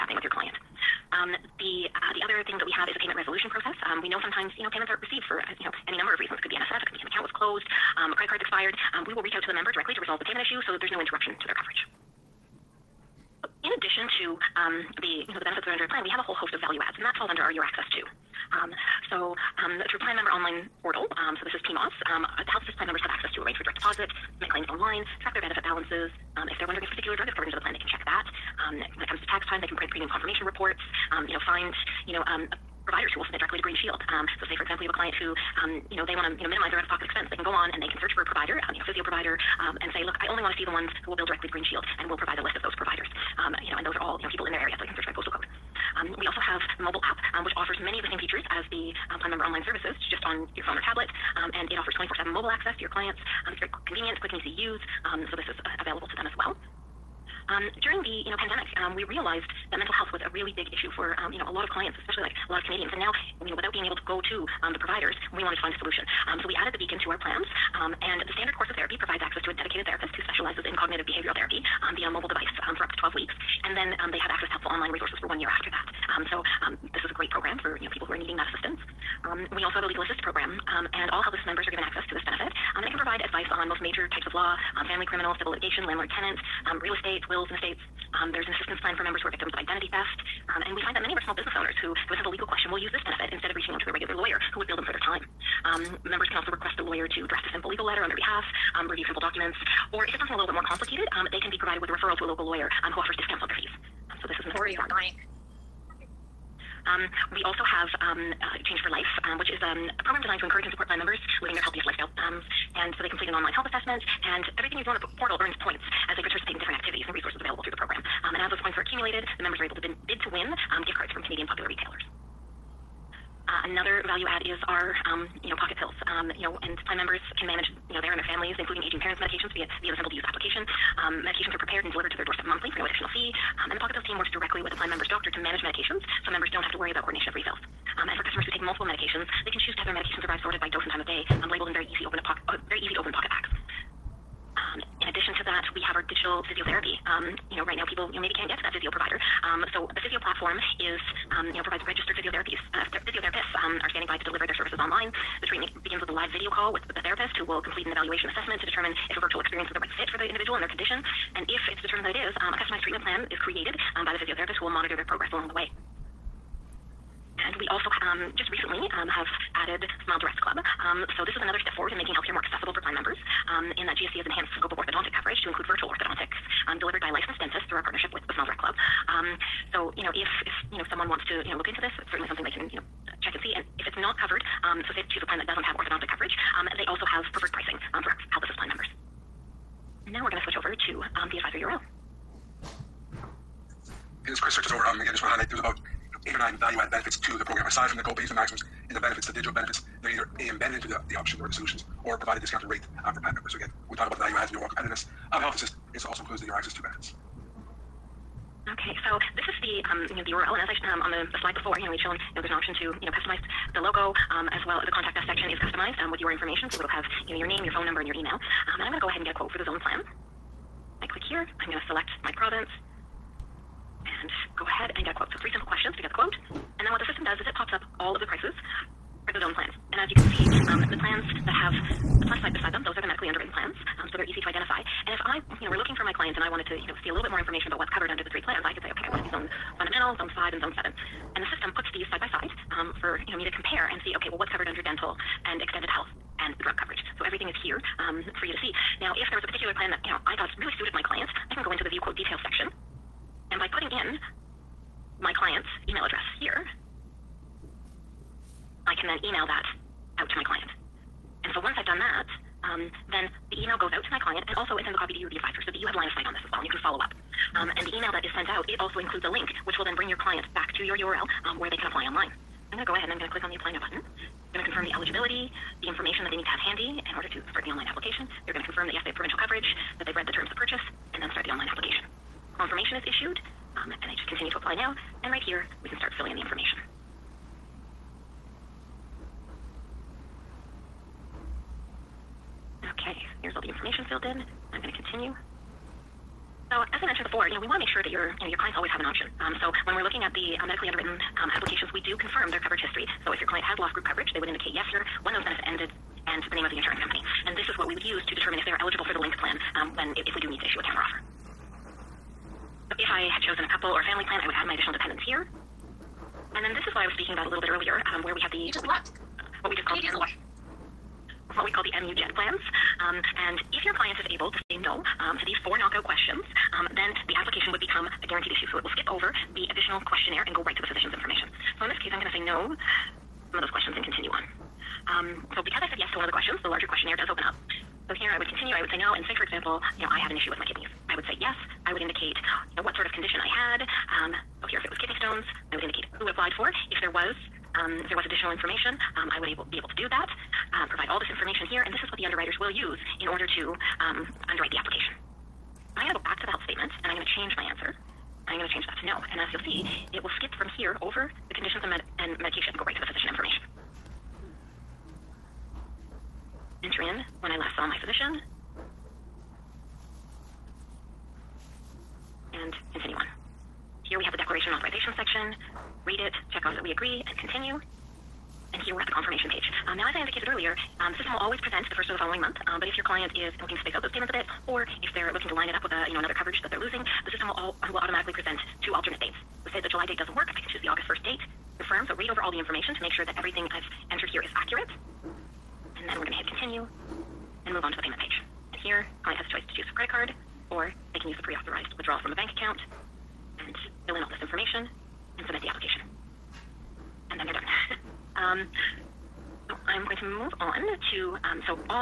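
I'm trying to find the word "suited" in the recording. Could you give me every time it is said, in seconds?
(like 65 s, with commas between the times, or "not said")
250 s.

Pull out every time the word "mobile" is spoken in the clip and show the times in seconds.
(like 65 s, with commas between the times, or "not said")
46 s, 52 s, 72 s.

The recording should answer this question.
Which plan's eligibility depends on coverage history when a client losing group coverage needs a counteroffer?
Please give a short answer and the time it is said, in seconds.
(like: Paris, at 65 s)
link plan, at 309 s.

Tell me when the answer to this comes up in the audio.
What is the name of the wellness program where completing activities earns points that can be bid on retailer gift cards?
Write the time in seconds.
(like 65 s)
108 s.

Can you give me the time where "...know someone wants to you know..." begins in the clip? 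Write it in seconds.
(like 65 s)
180 s.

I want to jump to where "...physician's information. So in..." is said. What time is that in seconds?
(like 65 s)
330 s.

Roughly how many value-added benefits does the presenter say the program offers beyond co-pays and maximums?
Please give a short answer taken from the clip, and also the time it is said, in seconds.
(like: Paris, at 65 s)
8 or 9, at 196 s.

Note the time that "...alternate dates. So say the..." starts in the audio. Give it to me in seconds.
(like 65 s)
388 s.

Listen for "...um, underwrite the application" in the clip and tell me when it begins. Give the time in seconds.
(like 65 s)
353 s.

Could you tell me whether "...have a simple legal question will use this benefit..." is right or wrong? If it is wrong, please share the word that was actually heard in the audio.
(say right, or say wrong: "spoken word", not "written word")
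right.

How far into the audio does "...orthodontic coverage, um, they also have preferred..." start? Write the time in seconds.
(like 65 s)
185 s.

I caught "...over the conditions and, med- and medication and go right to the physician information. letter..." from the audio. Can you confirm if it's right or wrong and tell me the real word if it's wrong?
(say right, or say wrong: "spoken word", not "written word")
wrong: "enter", not "letter".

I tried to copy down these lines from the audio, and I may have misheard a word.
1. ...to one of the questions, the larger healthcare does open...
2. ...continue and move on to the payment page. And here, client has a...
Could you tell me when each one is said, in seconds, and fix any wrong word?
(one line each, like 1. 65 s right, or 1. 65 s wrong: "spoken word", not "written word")
1. 336 s wrong: "questionnaire", not "healthcare"
2. 396 s right.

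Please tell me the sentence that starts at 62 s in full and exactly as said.
And now you know, without being able to go to um, the providers, we wanted to find a solution.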